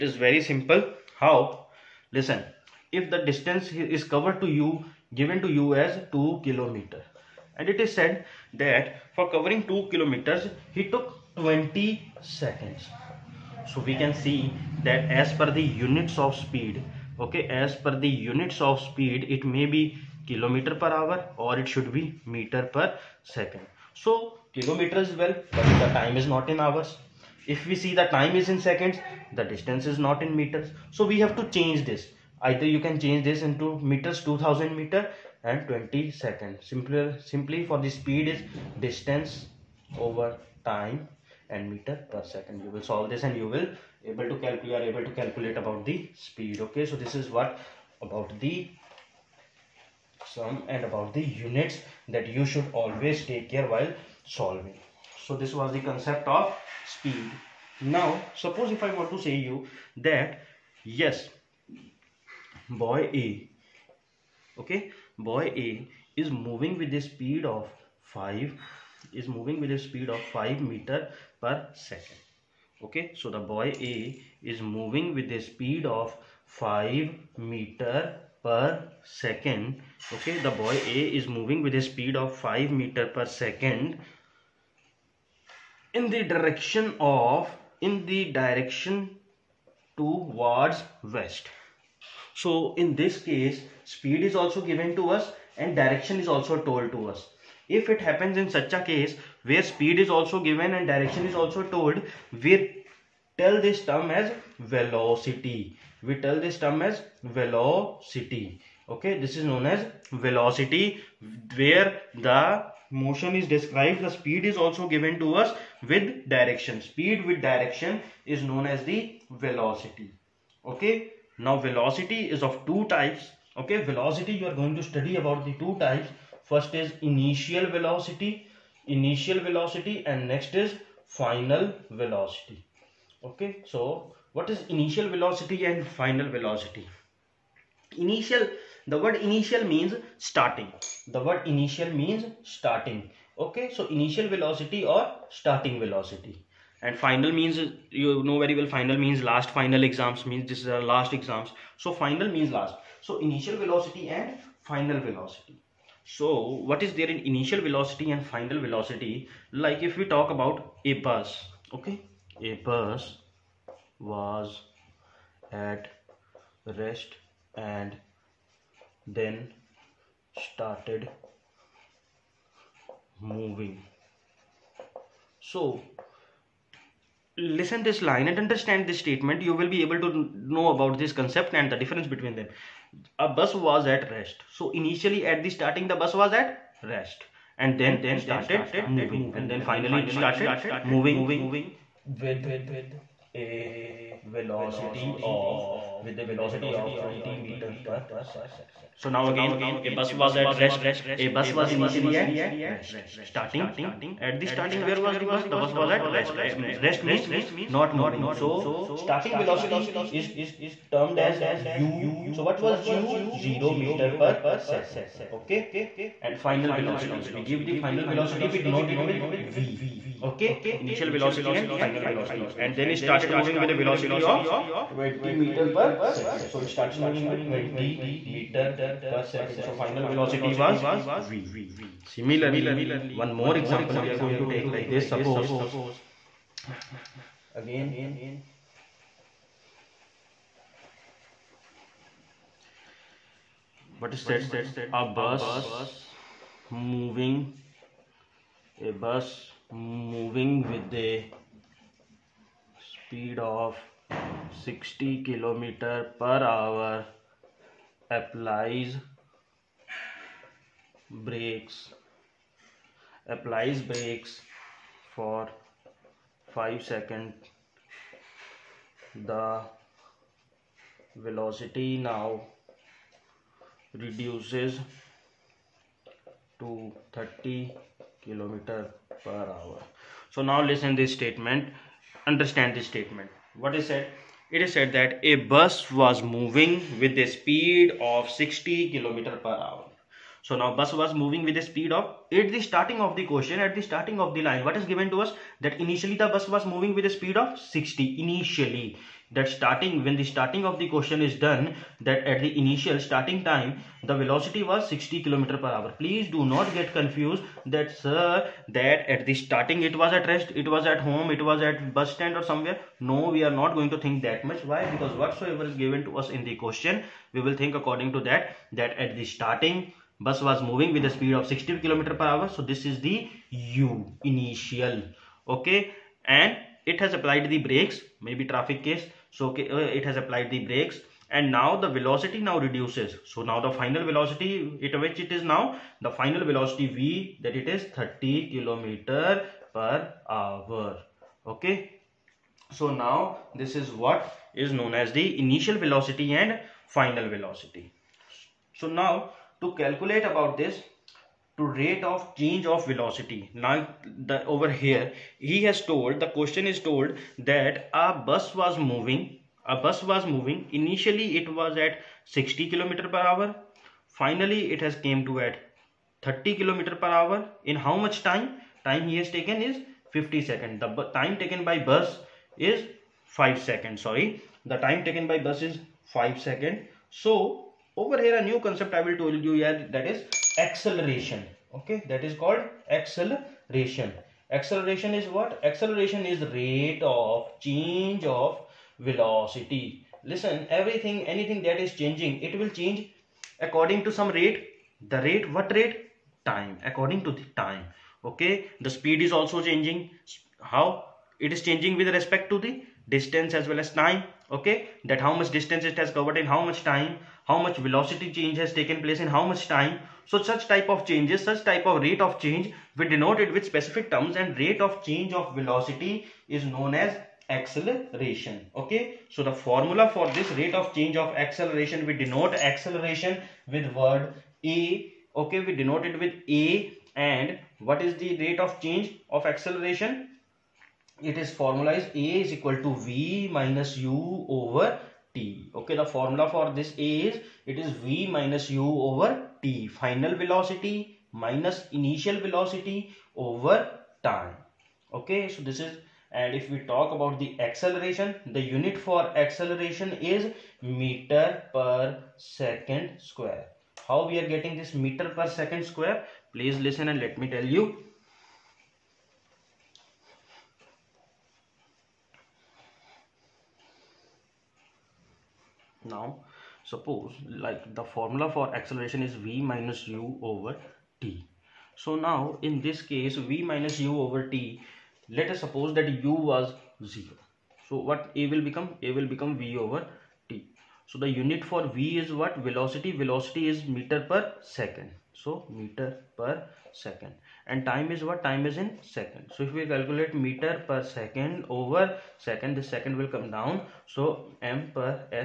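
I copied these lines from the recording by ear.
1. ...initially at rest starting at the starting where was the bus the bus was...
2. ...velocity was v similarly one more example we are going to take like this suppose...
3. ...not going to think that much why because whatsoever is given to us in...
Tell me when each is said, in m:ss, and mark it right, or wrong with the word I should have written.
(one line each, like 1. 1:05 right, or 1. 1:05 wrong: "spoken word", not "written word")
1. 3:21 right
2. 3:50 right
3. 5:13 right.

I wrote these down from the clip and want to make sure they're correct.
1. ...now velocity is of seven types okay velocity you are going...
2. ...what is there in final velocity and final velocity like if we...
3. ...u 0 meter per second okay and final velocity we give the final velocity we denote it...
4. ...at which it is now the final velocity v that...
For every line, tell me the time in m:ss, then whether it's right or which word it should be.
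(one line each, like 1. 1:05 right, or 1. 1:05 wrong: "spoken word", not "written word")
1. 2:01 wrong: "two", not "seven"
2. 2:36 wrong: "initial", not "final"
3. 3:32 right
4. 5:34 right.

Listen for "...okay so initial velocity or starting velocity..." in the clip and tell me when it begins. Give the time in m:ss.
2:23.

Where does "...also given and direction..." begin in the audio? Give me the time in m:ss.
1:40.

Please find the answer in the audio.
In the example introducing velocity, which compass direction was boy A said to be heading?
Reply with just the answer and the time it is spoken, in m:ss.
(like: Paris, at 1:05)
west, at 1:31.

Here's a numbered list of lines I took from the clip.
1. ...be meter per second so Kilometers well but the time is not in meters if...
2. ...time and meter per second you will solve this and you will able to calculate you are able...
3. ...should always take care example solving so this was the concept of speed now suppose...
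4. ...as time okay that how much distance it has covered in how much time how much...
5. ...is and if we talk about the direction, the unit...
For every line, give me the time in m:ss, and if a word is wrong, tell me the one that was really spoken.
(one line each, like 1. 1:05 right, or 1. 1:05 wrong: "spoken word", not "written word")
1. 0:21 wrong: "hours", not "meters"
2. 0:40 right
3. 0:52 wrong: "while", not "example"
4. 6:43 right
5. 7:25 wrong: "acceleration", not "direction".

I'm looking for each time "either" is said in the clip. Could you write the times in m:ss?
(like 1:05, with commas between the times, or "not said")
0:32.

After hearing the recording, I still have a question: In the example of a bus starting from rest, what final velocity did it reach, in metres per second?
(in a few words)
20 meters per second.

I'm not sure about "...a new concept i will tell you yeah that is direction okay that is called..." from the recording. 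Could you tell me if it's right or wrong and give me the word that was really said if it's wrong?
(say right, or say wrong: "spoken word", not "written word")
wrong: "acceleration", not "direction".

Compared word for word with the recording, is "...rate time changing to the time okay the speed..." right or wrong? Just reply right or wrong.
wrong.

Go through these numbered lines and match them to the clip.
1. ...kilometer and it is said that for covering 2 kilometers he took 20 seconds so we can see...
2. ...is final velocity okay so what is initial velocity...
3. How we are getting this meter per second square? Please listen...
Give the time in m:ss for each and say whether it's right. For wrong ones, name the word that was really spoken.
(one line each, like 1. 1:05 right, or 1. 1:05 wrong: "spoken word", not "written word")
1. 0:06 right
2. 2:10 right
3. 7:34 right.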